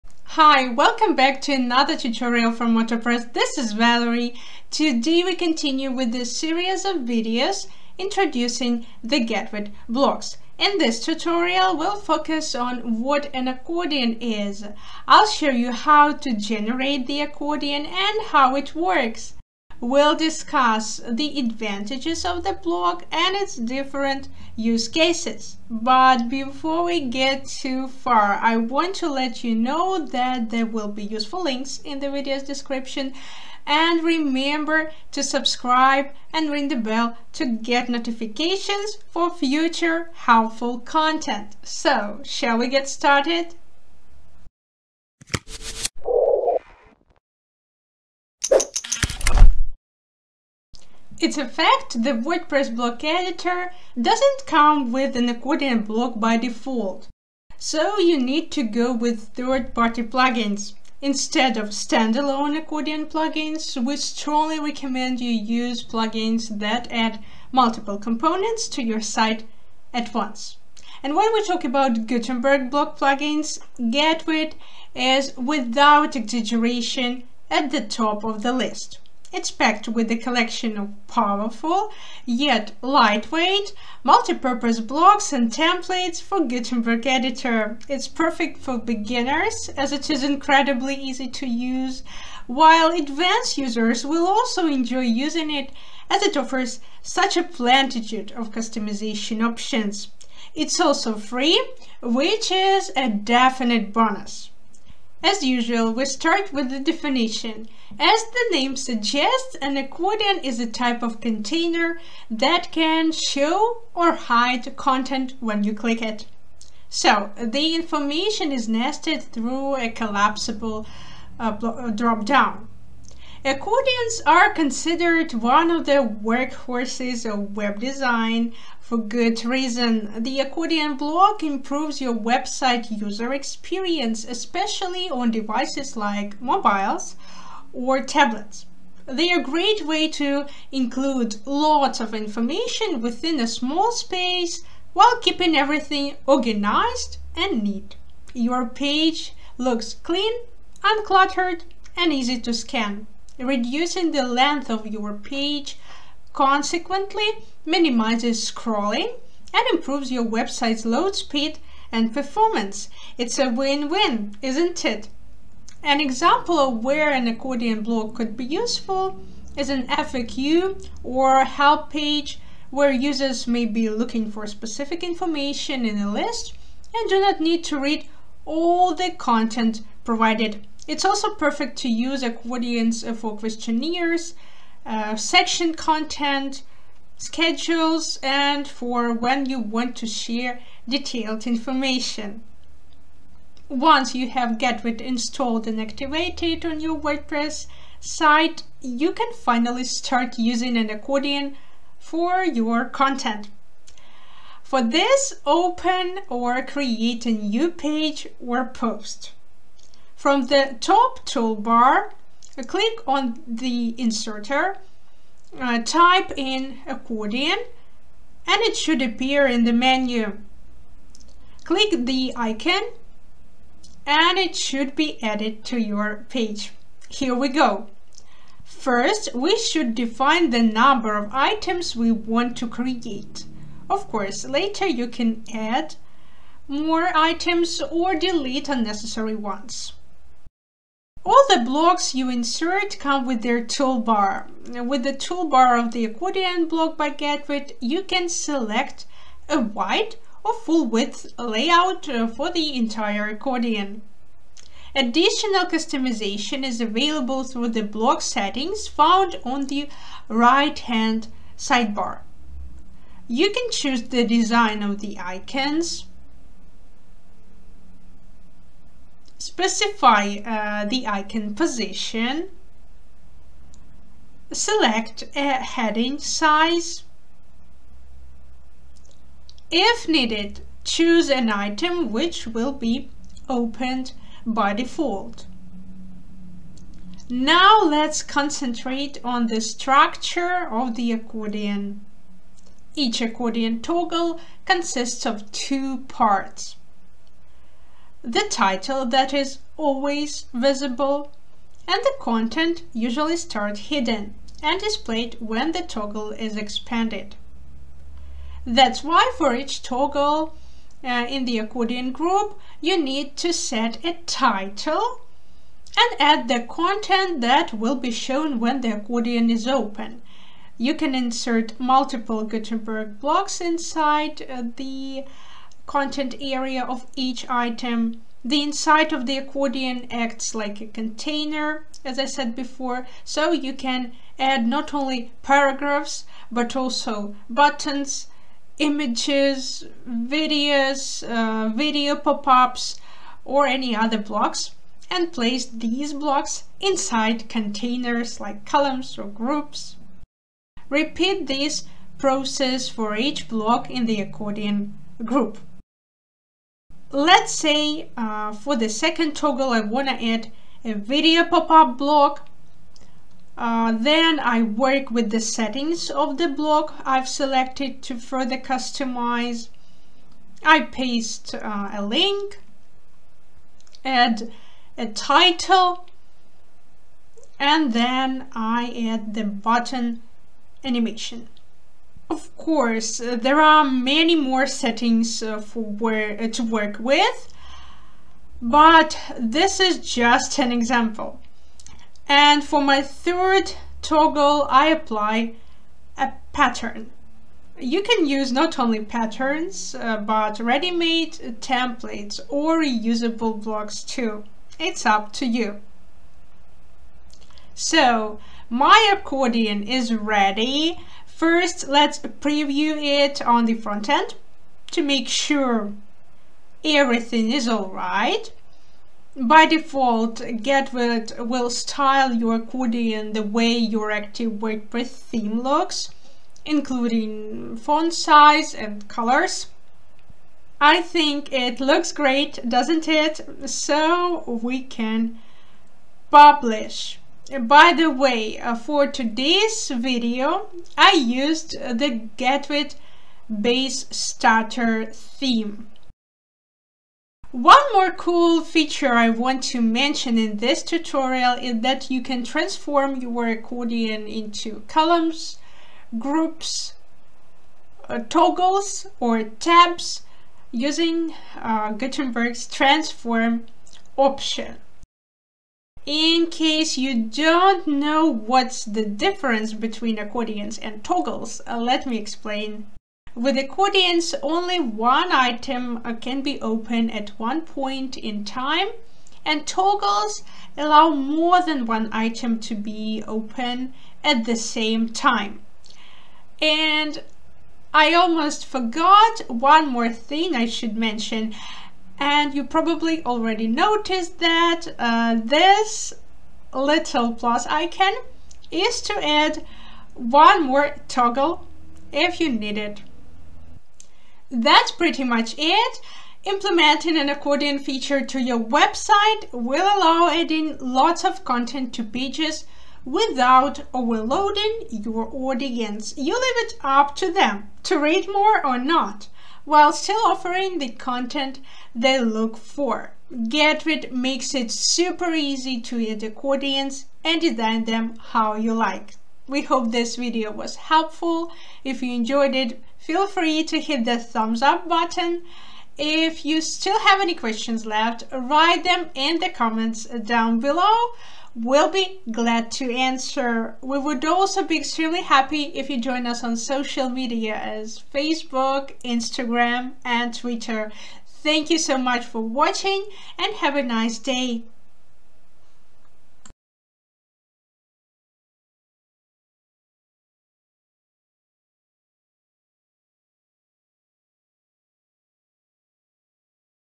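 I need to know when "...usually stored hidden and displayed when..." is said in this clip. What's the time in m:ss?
5:02.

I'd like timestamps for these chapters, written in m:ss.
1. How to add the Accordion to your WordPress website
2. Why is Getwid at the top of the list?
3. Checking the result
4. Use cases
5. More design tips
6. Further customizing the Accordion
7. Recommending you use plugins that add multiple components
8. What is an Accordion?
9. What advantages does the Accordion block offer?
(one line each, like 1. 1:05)
1. 3:12
2. 1:10
3. 6:45
4. 2:44
5. 7:26
6. 4:00
7. 0:50
8. 1:44
9. 2:02.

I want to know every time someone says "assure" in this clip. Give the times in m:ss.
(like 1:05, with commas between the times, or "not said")
not said.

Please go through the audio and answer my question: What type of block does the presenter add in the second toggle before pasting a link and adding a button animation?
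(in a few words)
Video pop-up.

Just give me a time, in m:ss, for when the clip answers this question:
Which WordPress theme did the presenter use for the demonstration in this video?
7:22.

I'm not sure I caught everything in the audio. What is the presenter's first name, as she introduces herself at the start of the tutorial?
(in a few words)
Valerie.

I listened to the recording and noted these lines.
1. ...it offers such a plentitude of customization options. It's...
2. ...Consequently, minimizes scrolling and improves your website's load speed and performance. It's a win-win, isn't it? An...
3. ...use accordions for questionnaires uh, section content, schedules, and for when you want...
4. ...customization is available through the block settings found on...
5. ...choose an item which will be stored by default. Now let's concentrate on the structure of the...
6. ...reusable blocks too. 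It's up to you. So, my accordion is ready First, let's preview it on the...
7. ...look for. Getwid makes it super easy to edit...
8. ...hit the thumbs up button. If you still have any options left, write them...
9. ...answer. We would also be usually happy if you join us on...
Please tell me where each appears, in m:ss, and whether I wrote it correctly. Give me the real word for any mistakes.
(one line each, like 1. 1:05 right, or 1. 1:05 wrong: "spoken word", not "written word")
1. 1:36 right
2. 2:36 right
3. 3:01 right
4. 4:15 right
5. 4:40 wrong: "opened", not "stored"
6. 6:42 right
7. 8:42 right
8. 8:53 wrong: "questions", not "options"
9. 9:02 wrong: "extremely", not "usually".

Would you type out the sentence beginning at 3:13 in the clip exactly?
Once you have Getwid installed and activated on your WordPress site, you can finally start using an accordion for your content.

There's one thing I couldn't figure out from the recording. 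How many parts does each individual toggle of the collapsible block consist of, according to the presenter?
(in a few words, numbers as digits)
2.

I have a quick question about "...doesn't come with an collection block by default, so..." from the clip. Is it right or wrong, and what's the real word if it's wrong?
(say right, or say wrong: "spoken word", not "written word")
wrong: "accordion", not "collection".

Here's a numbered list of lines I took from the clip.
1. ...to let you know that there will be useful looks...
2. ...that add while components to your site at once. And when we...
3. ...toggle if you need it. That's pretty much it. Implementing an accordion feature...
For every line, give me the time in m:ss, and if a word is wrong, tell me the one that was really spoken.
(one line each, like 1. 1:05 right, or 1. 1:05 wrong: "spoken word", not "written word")
1. 0:28 wrong: "links", not "looks"
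2. 1:06 wrong: "multiple", not "while"
3. 8:21 right.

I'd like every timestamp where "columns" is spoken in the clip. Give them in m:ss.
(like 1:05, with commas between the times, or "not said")
5:48, 7:34.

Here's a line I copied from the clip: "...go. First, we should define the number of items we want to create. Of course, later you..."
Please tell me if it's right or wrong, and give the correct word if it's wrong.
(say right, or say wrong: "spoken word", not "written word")
right.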